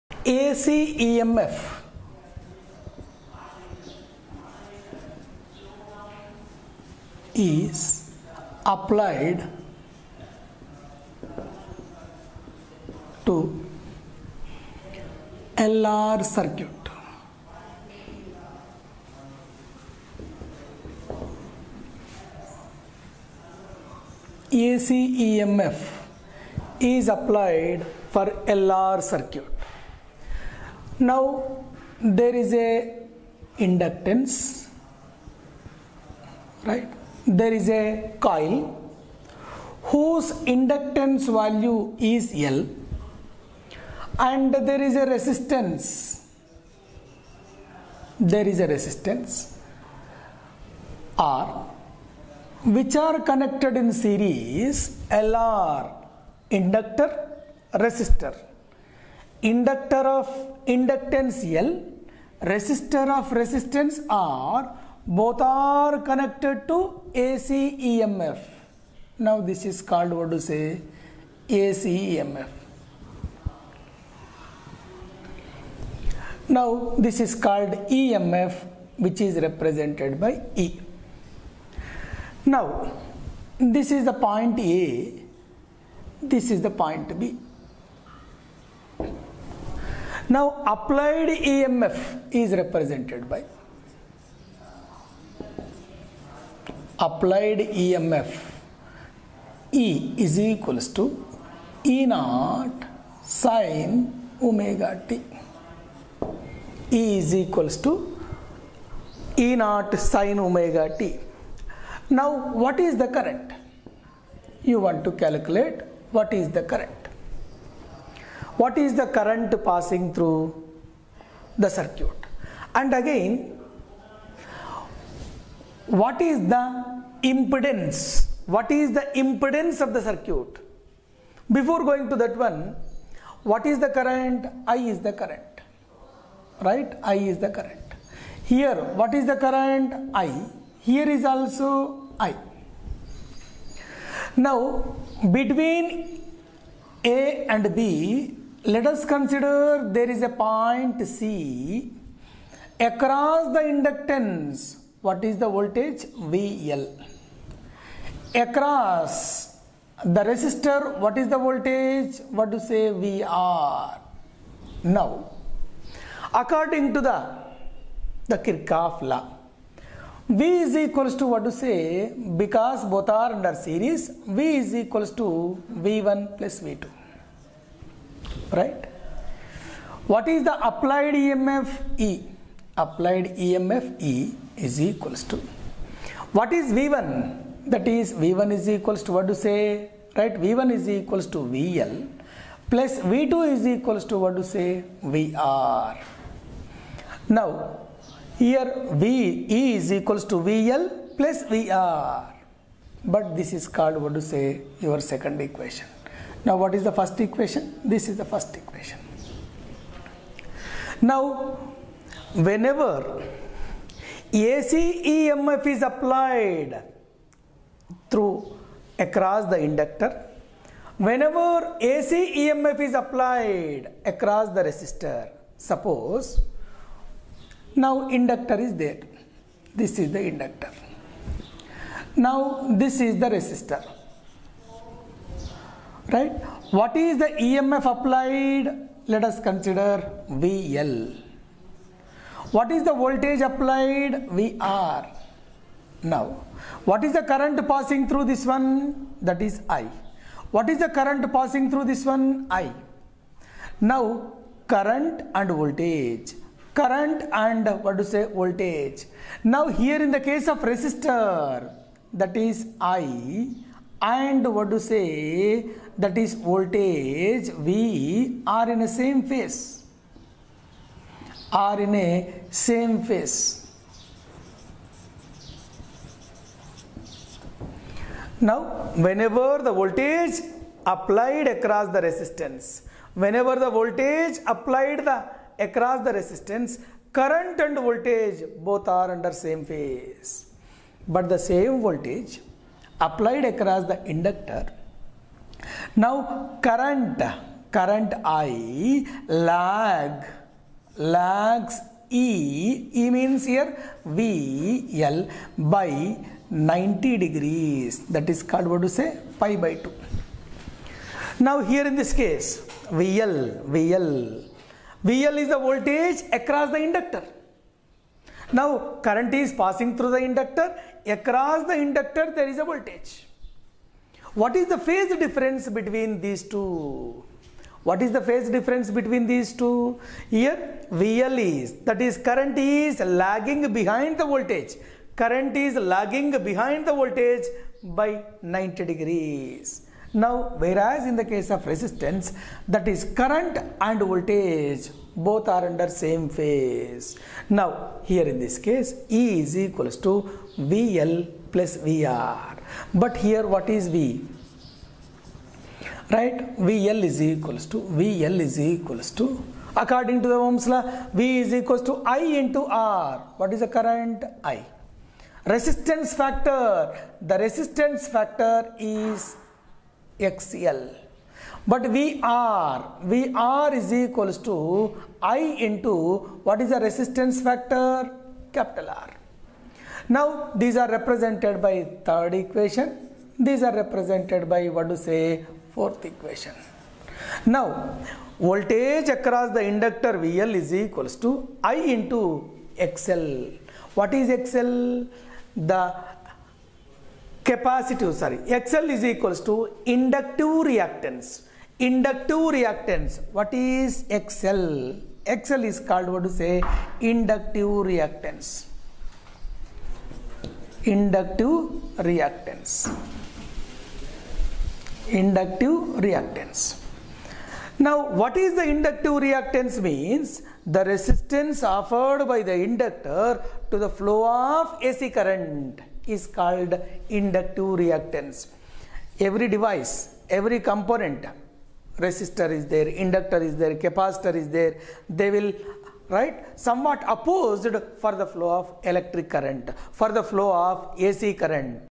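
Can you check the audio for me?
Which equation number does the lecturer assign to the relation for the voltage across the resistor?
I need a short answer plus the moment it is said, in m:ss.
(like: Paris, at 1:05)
fourth, at 6:25.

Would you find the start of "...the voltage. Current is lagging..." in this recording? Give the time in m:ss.
5:34.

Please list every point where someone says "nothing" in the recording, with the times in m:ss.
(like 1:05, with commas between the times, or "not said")
not said.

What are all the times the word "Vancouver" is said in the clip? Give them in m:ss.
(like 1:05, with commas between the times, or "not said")
not said.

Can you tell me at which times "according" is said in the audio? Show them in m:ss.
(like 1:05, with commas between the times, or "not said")
2:46, 5:59.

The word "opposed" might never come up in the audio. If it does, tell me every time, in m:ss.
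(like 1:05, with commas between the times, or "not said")
7:17.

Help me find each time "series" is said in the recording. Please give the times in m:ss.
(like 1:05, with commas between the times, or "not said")
0:54, 2:53.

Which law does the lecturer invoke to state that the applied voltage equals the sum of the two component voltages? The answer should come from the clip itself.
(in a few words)
Kirchhoff law.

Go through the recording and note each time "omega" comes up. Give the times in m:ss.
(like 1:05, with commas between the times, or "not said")
1:44, 1:50.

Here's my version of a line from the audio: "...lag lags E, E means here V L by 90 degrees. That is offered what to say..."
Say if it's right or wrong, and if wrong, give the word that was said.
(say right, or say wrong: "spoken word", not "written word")
wrong: "called", not "offered".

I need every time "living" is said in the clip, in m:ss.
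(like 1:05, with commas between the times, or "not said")
not said.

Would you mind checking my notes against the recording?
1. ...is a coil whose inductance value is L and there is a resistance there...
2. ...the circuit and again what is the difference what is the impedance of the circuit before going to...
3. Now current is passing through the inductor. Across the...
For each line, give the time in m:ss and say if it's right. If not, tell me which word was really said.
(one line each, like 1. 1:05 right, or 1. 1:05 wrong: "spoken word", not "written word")
1. 0:37 right
2. 2:01 wrong: "impedance", not "difference"
3. 5:18 right.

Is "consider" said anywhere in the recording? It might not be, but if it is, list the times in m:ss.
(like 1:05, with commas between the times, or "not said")
2:29, 3:59.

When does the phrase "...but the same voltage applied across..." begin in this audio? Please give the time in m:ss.
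4:51.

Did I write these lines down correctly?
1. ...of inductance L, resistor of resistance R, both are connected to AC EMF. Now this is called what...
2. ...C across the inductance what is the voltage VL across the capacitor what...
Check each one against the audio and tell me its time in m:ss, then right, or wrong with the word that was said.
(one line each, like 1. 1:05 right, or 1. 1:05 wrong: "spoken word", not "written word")
1. 1:00 right
2. 2:31 wrong: "resistor", not "capacitor".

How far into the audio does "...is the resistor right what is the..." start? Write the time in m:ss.
3:52.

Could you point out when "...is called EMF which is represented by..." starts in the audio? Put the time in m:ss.
1:17.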